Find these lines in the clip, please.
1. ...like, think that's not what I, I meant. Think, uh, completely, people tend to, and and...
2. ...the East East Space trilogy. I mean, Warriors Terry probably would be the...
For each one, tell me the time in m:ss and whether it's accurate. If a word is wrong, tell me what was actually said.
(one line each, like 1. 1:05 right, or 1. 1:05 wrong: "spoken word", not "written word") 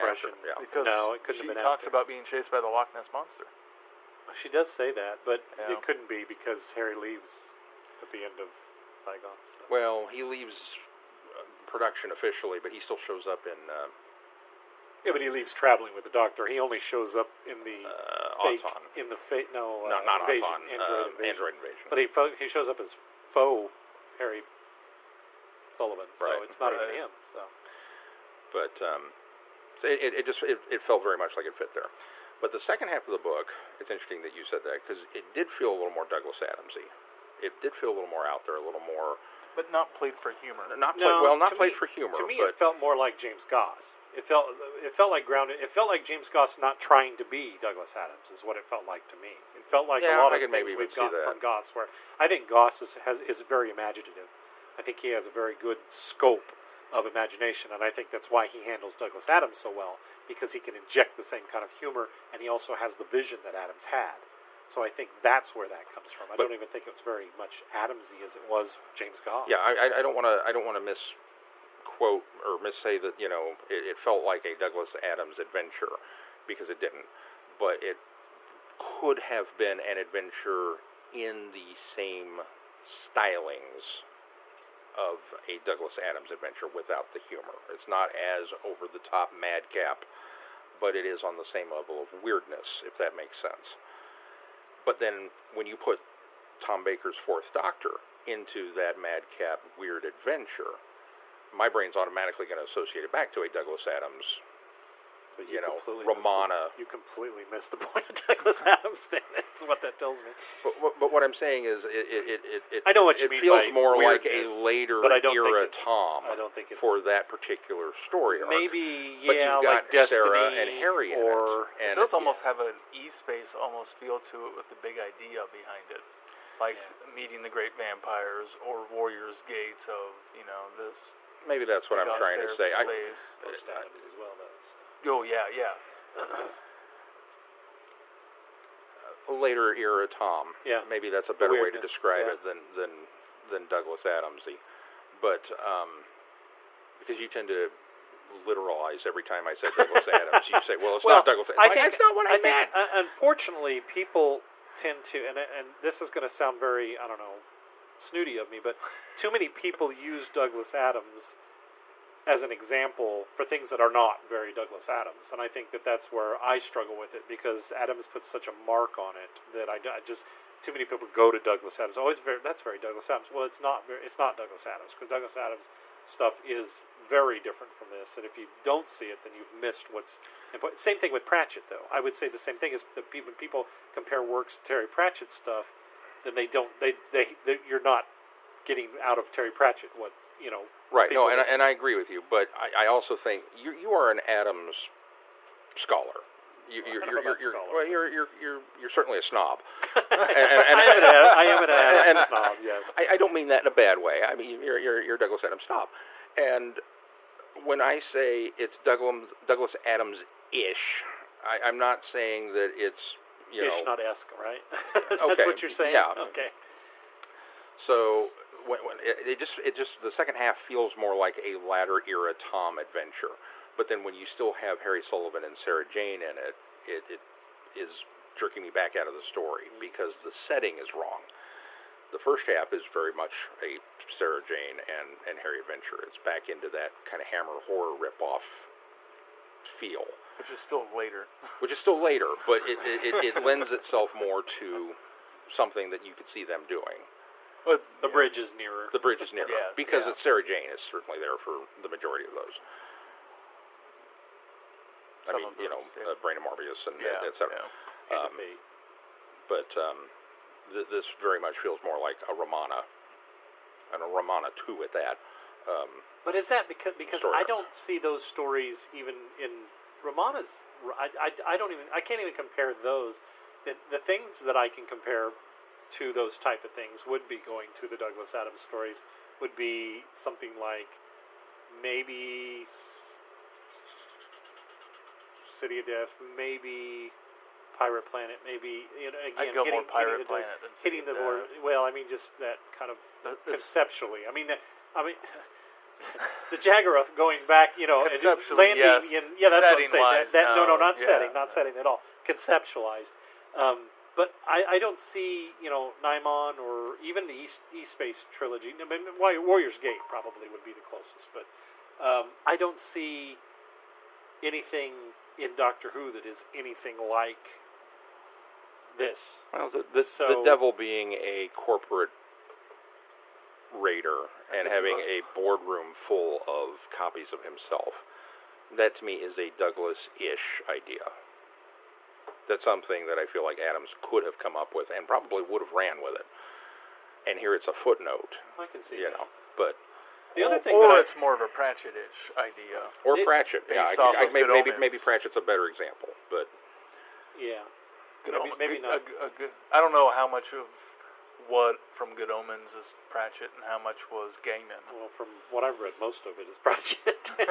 1. 2:31 wrong: "unfortunately", not "completely"
2. 5:07 wrong: "Gate", not "Terry".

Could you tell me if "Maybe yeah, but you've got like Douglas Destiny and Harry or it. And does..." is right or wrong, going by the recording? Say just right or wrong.
wrong.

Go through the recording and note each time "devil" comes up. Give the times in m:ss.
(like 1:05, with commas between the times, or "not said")
5:20.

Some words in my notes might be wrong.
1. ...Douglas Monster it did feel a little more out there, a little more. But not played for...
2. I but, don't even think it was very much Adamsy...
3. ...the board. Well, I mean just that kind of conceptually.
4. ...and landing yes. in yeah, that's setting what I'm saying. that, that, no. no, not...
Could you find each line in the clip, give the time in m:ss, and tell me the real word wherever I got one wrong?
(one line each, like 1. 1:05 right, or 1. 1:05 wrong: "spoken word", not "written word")
1. 0:36 wrong: "Adamsy", not "Monster"
2. 1:06 right
3. 4:51 right
4. 4:58 right.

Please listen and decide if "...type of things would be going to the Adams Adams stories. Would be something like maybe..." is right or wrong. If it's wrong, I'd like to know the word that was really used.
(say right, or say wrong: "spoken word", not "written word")
wrong: "Douglas", not "Adams".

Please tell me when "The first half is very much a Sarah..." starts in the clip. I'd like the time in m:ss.
3:52.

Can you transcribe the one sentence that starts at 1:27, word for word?
It's not as over the top madcap, but it is on the same level of weirdness, if that makes sense.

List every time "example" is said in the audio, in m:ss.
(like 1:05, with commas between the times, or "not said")
2:42, 5:45.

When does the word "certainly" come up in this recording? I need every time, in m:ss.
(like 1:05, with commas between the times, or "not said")
3:18, 4:10.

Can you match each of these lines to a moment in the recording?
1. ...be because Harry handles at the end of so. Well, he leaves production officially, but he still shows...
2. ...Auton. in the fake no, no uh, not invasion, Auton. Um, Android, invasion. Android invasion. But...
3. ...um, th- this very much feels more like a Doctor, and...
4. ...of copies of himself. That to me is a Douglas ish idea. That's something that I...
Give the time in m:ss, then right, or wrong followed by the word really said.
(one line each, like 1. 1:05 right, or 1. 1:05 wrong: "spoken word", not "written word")
1. 0:06 wrong: "leaves", not "handles"
2. 0:18 right
3. 4:19 wrong: "Romana", not "Doctor"
4. 5:26 right.